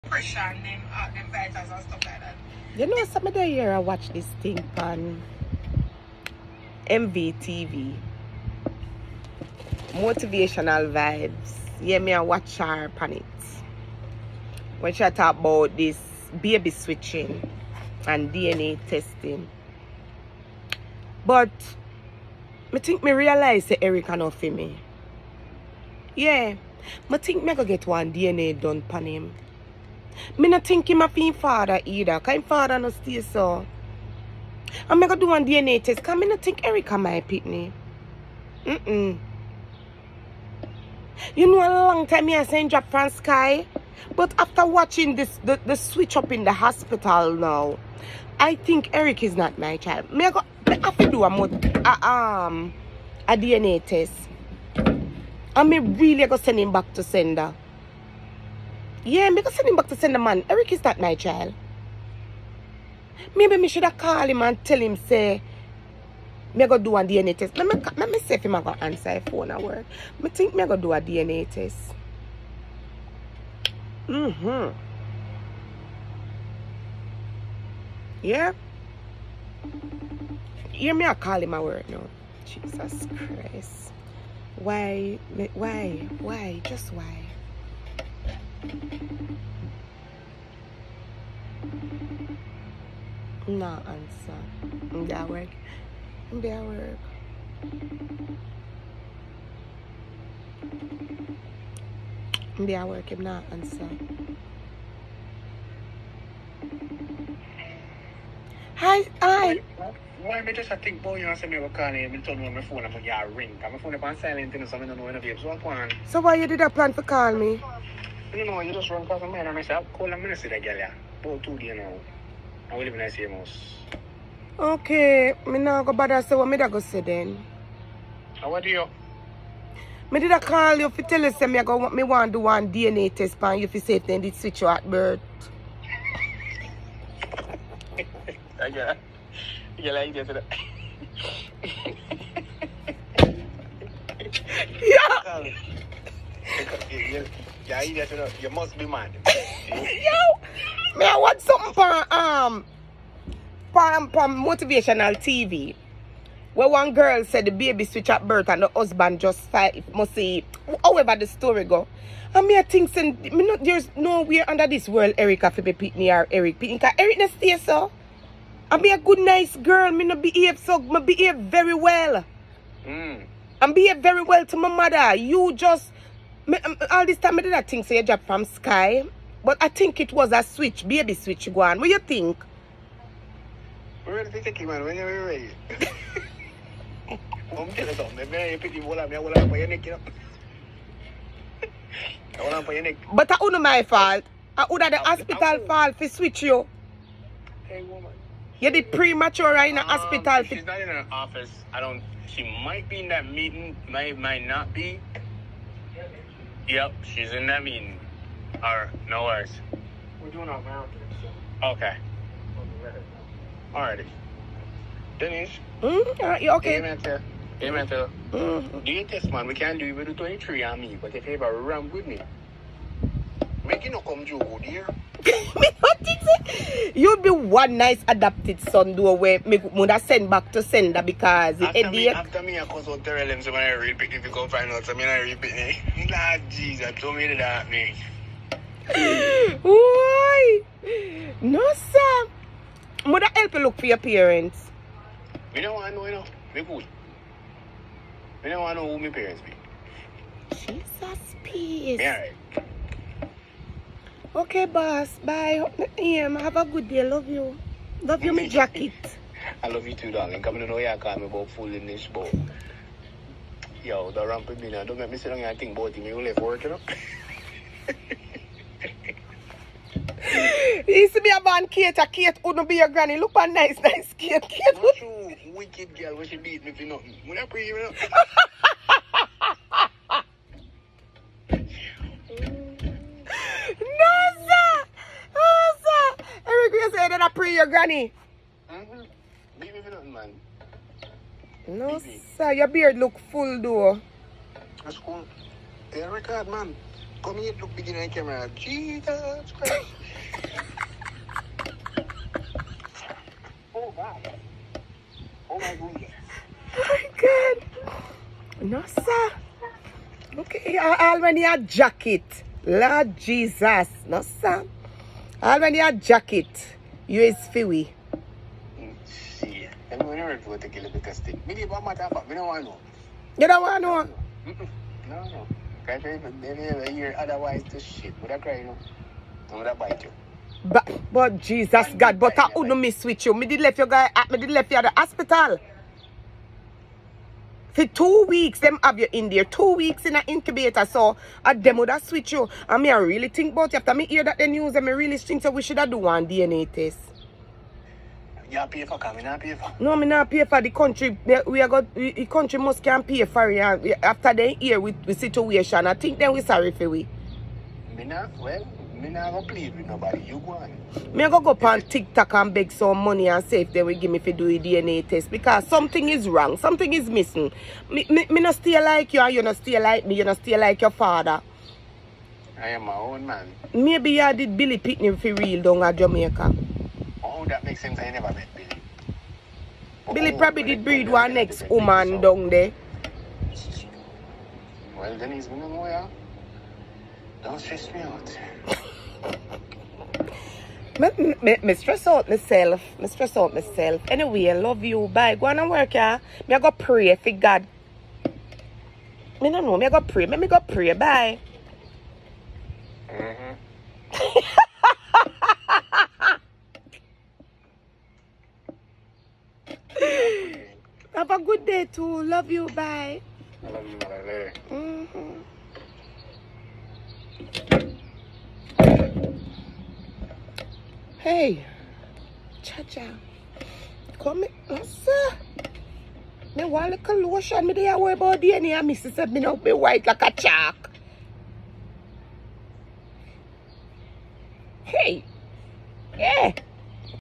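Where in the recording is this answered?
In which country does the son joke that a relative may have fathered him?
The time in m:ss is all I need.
6:15.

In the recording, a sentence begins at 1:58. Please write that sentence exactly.
You know, you just run past my mind and I say, I'll call a minister that girl.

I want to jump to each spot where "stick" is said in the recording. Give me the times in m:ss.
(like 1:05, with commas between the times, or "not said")
5:21.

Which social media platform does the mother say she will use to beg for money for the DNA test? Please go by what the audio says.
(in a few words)
TikTok.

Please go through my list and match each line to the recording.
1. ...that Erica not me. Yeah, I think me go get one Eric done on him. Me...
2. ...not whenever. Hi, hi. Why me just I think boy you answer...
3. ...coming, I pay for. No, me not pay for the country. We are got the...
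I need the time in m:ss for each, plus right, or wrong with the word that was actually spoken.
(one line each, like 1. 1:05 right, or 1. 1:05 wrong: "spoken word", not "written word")
1. 0:23 wrong: "DNA", not "Eric"
2. 1:43 wrong: "answer", not "whenever"
3. 5:48 right.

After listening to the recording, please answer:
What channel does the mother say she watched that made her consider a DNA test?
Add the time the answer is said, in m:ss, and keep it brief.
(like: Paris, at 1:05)
MVTV, at 0:06.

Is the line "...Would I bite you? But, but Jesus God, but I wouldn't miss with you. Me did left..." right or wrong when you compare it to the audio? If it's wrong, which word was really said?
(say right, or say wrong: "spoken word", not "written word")
right.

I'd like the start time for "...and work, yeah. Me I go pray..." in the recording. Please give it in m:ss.
6:35.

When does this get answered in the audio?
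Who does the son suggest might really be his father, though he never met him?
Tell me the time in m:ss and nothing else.
6:14.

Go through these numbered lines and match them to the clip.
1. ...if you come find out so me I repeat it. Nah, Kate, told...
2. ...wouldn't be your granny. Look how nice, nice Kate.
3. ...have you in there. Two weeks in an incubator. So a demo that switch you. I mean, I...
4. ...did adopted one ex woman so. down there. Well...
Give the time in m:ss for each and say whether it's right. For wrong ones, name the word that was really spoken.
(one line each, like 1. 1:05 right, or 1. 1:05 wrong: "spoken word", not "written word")
1. 3:54 wrong: "Jesus", not "Kate"
2. 4:32 right
3. 5:38 right
4. 6:20 wrong: "breed", not "adopted".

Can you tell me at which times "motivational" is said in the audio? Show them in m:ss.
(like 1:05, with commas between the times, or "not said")
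0:09, 2:34.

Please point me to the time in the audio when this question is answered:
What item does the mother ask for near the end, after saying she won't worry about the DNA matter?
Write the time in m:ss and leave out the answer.
7:07.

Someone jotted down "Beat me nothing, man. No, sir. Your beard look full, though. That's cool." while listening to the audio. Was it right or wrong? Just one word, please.
right.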